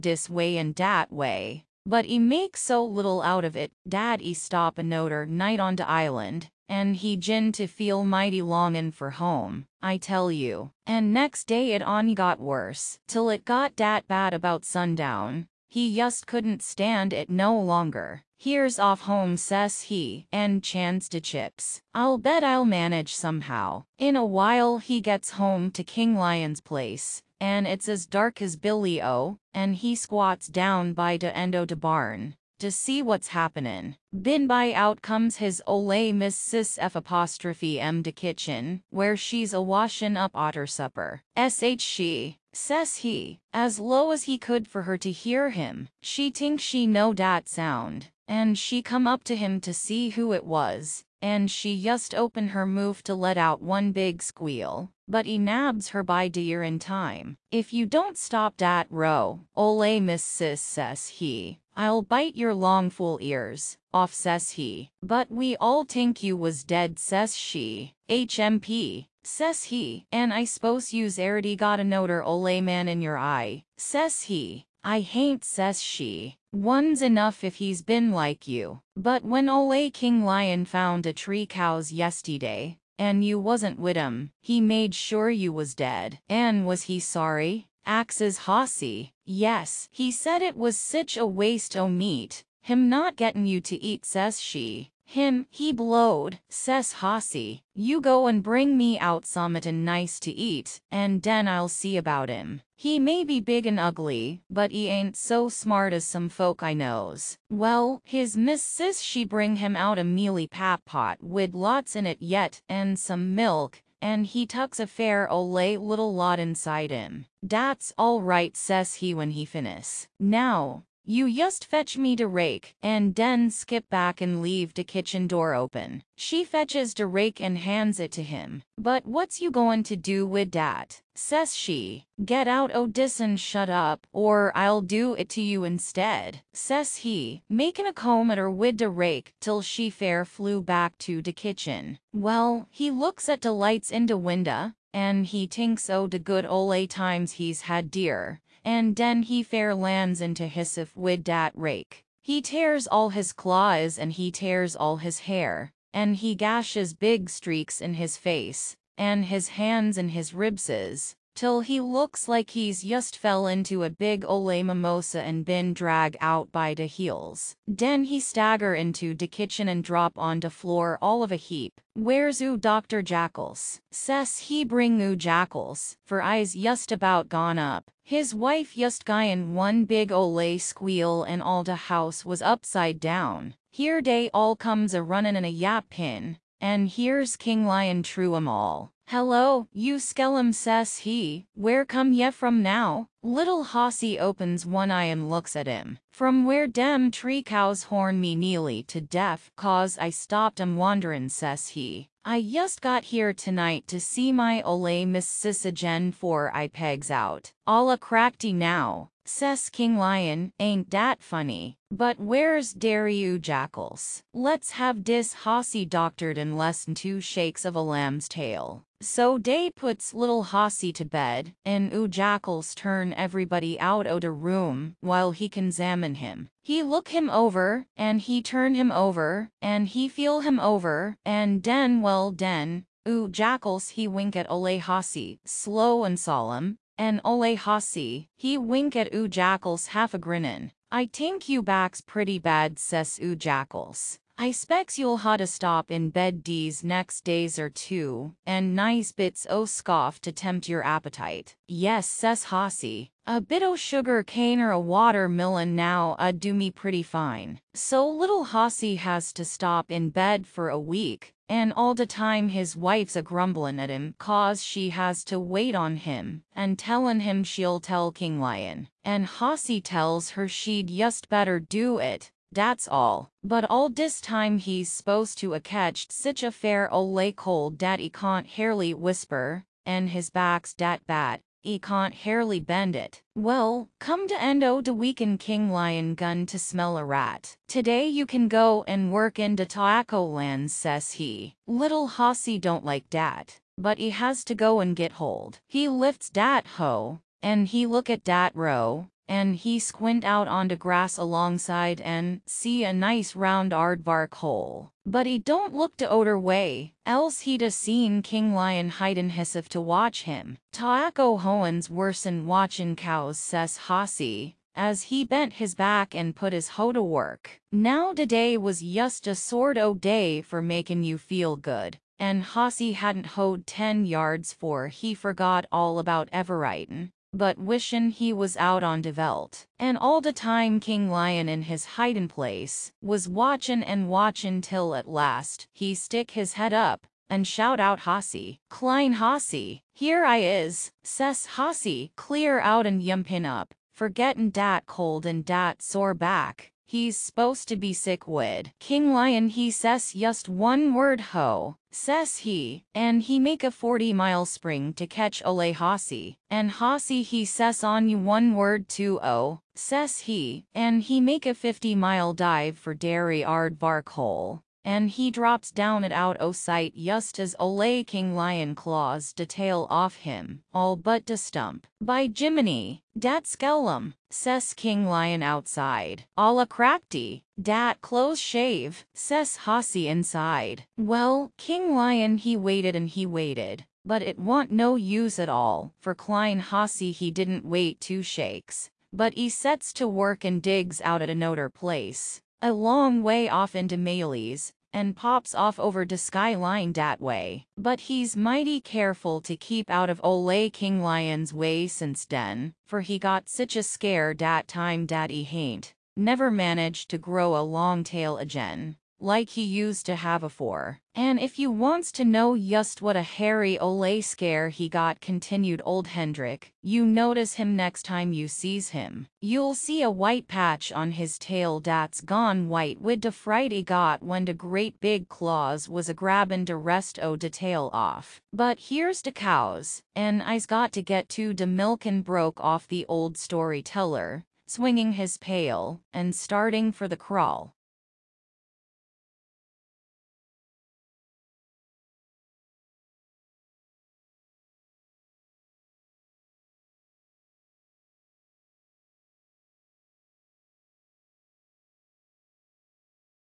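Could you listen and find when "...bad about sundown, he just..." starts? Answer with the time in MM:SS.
00:14.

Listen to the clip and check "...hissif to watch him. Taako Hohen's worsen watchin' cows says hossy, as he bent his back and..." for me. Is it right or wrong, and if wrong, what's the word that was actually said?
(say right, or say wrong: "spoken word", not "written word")
right.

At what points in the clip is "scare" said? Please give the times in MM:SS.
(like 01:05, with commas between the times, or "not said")
06:43, 06:54.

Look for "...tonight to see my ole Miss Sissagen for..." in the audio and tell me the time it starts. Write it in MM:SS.
03:23.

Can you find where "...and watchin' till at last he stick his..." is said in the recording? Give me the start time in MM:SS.
05:33.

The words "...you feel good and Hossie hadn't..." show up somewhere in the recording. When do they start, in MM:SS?
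05:21.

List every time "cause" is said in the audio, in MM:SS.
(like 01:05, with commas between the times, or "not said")
03:19, 04:24.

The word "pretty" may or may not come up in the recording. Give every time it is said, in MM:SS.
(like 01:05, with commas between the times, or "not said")
04:02, 04:16.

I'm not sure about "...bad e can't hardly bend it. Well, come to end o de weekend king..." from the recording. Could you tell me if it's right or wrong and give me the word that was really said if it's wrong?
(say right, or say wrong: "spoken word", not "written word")
right.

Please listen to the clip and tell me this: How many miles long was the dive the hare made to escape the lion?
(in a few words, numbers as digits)
50.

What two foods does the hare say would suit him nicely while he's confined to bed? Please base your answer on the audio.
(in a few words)
Sugar cane or a watermelon.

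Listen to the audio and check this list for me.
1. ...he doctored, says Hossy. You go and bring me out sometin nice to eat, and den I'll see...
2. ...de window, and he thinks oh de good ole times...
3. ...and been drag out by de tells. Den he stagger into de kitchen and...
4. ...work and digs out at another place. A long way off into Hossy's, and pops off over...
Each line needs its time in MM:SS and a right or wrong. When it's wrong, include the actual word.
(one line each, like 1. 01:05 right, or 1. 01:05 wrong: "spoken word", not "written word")
1. 01:35 wrong: "blowed", not "doctored"
2. 02:24 right
3. 02:45 wrong: "heels", not "tells"
4. 06:30 wrong: "Maley", not "Hossy".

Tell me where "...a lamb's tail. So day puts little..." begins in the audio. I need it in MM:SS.
03:37.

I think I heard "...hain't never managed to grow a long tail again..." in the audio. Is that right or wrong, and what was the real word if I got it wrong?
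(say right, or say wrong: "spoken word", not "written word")
right.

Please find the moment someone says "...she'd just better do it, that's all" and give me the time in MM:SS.
04:30.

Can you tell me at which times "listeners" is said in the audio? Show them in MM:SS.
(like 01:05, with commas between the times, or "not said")
not said.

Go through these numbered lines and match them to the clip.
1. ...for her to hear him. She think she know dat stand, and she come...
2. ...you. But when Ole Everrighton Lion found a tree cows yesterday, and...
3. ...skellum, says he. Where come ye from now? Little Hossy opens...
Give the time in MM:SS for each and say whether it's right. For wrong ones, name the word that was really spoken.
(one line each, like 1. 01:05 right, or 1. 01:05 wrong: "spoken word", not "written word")
1. 00:44 wrong: "sound", not "stand"
2. 01:18 wrong: "King", not "Everrighton"
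3. 03:09 right.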